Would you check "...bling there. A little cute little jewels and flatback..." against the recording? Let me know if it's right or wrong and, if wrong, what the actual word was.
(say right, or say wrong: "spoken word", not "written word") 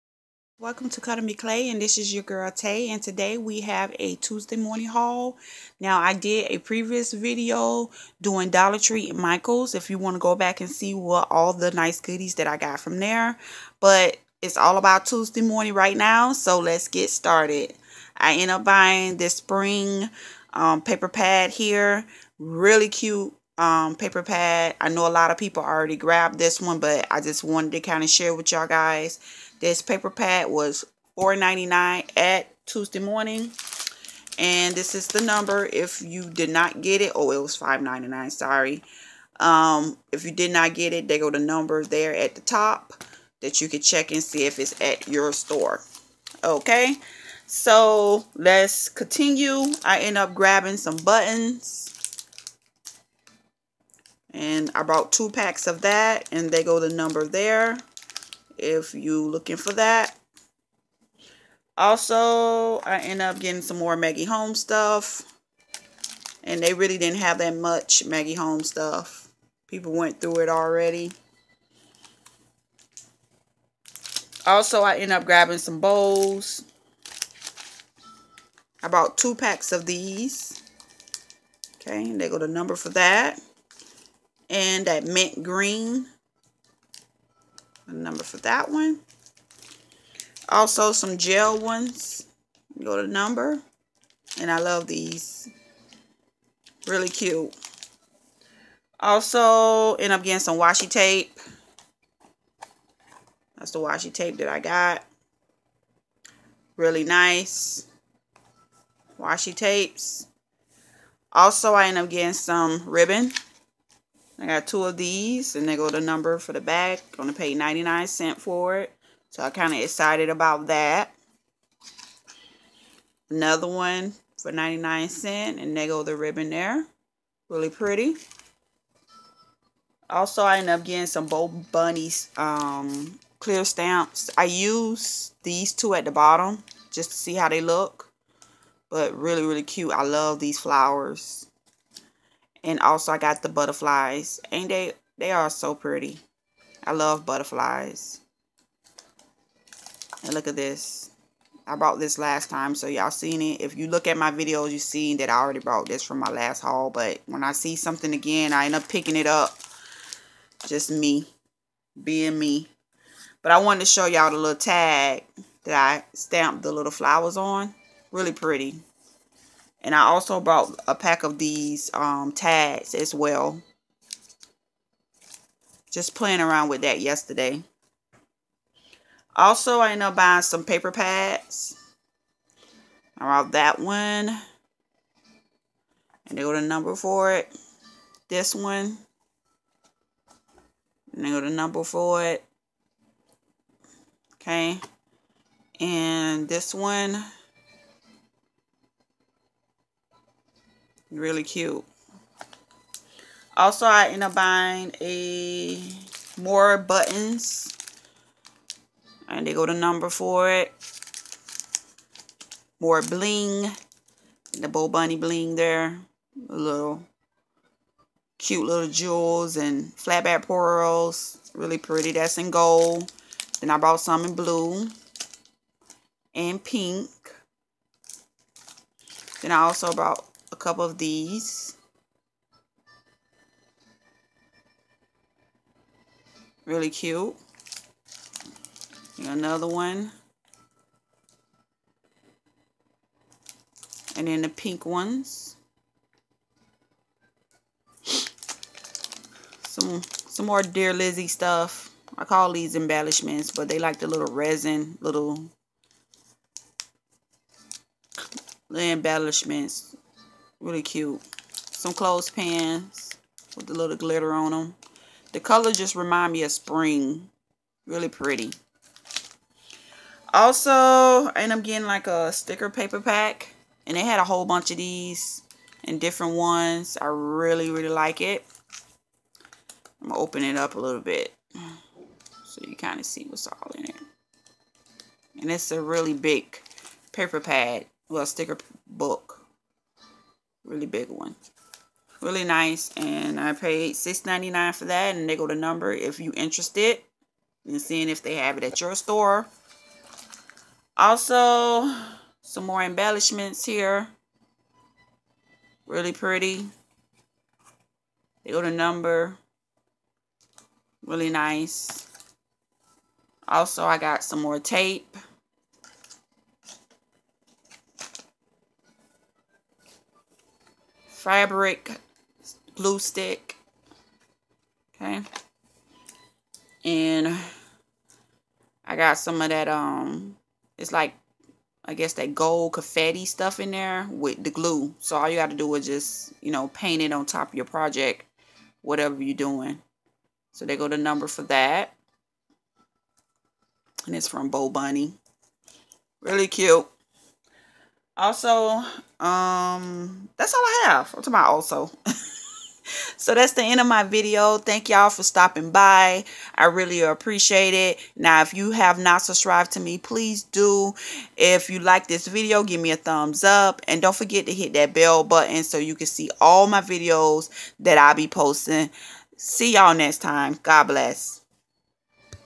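right.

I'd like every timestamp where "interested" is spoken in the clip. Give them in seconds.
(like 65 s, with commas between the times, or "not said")
296 s.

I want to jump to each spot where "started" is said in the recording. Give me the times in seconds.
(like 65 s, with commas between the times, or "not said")
17 s.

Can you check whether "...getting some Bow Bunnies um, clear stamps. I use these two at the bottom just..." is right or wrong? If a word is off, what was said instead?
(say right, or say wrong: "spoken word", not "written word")
right.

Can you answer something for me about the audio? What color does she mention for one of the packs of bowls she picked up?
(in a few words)
mint green.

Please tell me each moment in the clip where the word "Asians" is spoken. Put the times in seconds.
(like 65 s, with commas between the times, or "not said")
not said.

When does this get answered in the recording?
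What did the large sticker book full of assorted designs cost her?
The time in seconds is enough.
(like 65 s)
293 s.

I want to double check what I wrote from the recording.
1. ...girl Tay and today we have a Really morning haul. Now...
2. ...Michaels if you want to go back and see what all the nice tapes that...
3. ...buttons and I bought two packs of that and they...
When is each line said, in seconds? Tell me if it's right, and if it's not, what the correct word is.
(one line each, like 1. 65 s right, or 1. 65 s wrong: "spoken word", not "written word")
1. 2 s wrong: "Tuesday", not "Really"
2. 9 s wrong: "goodies", not "tapes"
3. 50 s right.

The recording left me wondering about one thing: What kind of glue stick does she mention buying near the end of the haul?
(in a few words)
fabric glue stick.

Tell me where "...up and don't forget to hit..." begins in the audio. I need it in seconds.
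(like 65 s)
363 s.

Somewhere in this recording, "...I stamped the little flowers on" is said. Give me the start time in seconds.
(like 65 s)
165 s.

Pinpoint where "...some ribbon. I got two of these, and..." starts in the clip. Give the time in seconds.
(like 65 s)
112 s.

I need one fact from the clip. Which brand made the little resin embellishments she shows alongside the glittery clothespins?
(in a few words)
Dear Lizzy.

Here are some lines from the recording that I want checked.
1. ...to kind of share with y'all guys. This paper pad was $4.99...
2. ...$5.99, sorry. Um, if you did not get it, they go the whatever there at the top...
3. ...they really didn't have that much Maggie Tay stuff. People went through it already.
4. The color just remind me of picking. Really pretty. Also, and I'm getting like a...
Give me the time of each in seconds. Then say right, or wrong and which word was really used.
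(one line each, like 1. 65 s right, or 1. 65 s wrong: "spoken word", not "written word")
1. 27 s right
2. 37 s wrong: "number", not "whatever"
3. 66 s wrong: "Holmes", not "Tay"
4. 265 s wrong: "spring", not "picking".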